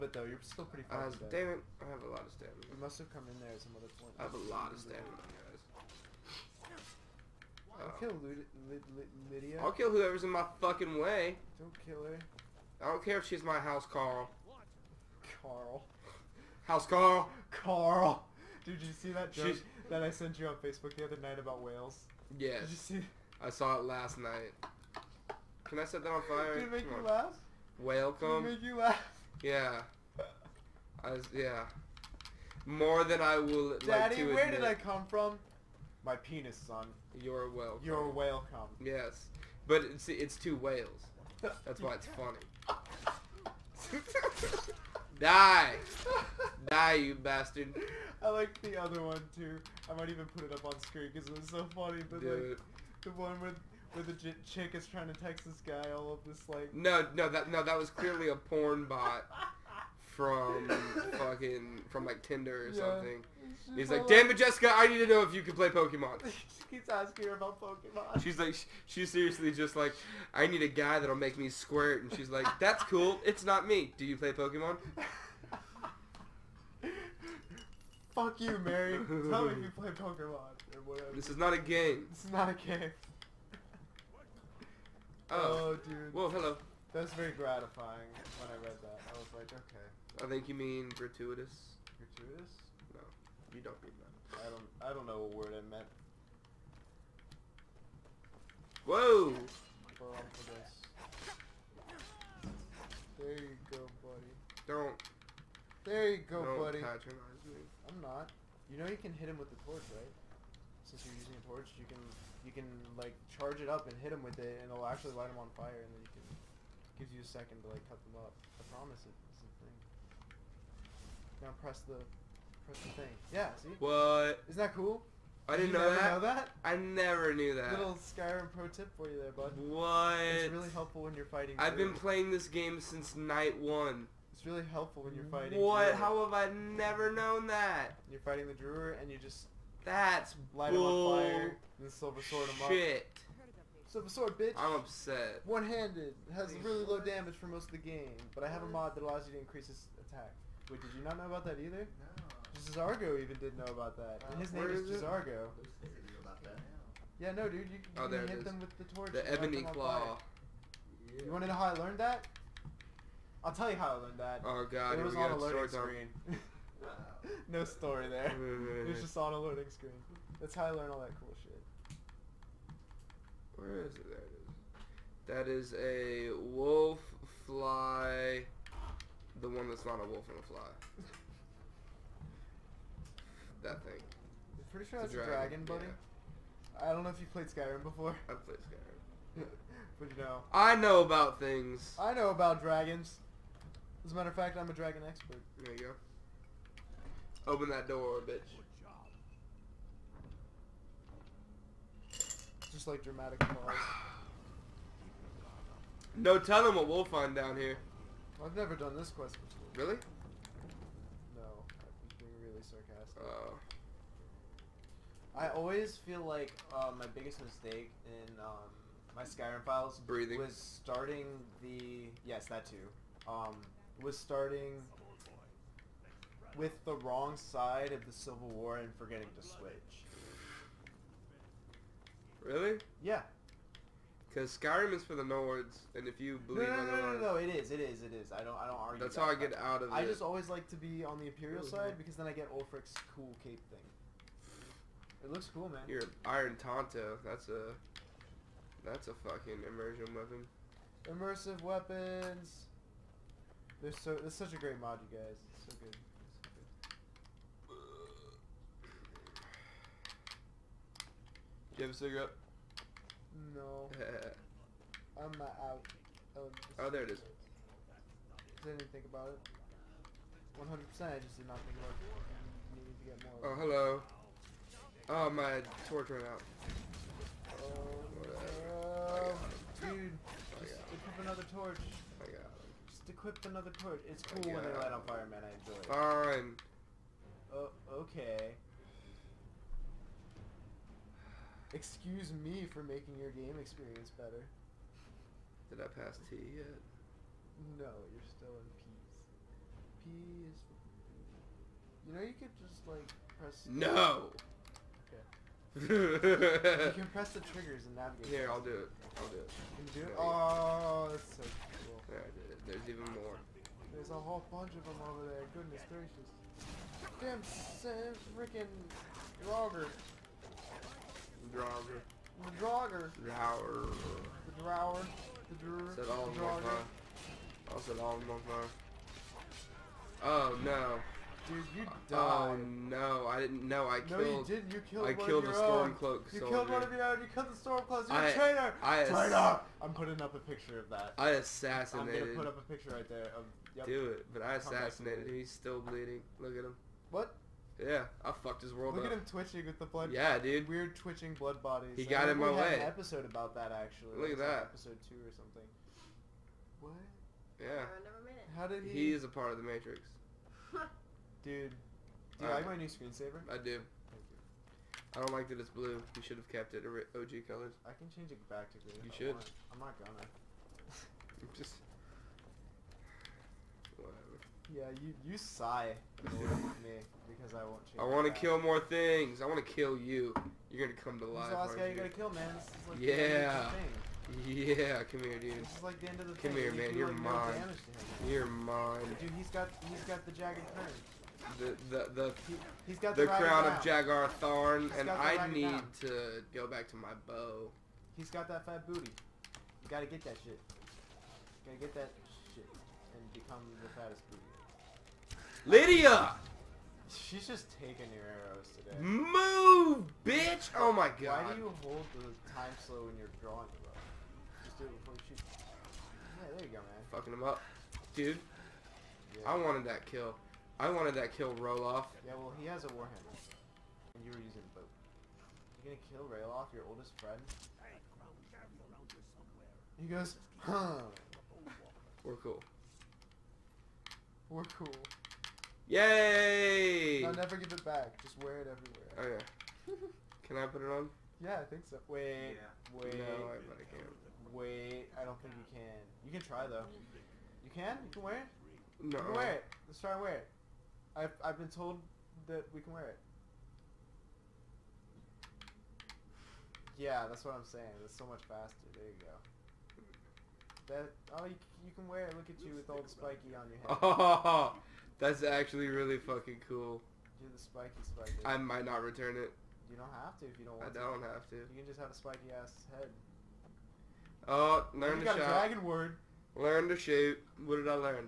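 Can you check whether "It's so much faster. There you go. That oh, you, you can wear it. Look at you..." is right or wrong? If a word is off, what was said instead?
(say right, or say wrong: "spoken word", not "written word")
right.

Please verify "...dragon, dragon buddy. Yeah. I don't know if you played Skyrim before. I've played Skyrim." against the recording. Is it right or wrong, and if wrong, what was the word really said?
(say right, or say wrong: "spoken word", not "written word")
right.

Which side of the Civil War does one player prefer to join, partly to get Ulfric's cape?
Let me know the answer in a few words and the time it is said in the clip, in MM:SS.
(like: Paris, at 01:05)
Imperial, at 04:01.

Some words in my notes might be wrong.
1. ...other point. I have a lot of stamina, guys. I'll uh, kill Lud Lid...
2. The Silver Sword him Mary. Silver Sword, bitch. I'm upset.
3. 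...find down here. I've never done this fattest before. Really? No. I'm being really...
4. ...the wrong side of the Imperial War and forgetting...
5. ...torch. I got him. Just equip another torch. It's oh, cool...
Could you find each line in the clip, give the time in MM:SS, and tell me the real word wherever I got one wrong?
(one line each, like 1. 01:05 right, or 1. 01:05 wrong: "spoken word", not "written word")
1. 00:03 right
2. 02:21 wrong: "Shit", not "Mary"
3. 03:27 wrong: "quest", not "fattest"
4. 03:46 wrong: "Civil", not "Imperial"
5. 04:41 right.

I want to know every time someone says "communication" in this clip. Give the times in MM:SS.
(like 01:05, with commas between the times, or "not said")
not said.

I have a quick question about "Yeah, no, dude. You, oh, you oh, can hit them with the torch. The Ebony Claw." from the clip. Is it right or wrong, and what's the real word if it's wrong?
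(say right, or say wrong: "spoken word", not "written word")
right.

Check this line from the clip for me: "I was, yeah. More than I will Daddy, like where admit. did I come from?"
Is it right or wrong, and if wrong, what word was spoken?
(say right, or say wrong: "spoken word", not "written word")
right.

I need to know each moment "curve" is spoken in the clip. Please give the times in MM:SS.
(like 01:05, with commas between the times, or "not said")
06:30.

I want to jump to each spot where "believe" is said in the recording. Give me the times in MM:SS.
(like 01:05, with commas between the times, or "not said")
03:56.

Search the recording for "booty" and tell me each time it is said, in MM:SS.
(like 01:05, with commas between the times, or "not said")
06:38, 06:44.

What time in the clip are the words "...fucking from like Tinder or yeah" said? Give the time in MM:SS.
01:01.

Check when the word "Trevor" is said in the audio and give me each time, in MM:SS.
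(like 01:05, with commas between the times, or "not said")
not said.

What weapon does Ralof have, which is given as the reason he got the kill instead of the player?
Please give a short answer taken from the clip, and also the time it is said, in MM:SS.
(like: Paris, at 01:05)
A warhammer, at 07:02.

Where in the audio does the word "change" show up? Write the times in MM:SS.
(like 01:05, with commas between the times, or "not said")
06:08, 06:17.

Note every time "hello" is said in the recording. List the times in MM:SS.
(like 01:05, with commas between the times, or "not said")
01:26, 04:33.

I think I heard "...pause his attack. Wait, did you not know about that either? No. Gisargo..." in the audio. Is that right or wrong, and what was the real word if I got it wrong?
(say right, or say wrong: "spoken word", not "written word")
wrong: "increase", not "pause".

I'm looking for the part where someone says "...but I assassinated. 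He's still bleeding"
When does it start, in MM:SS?
05:44.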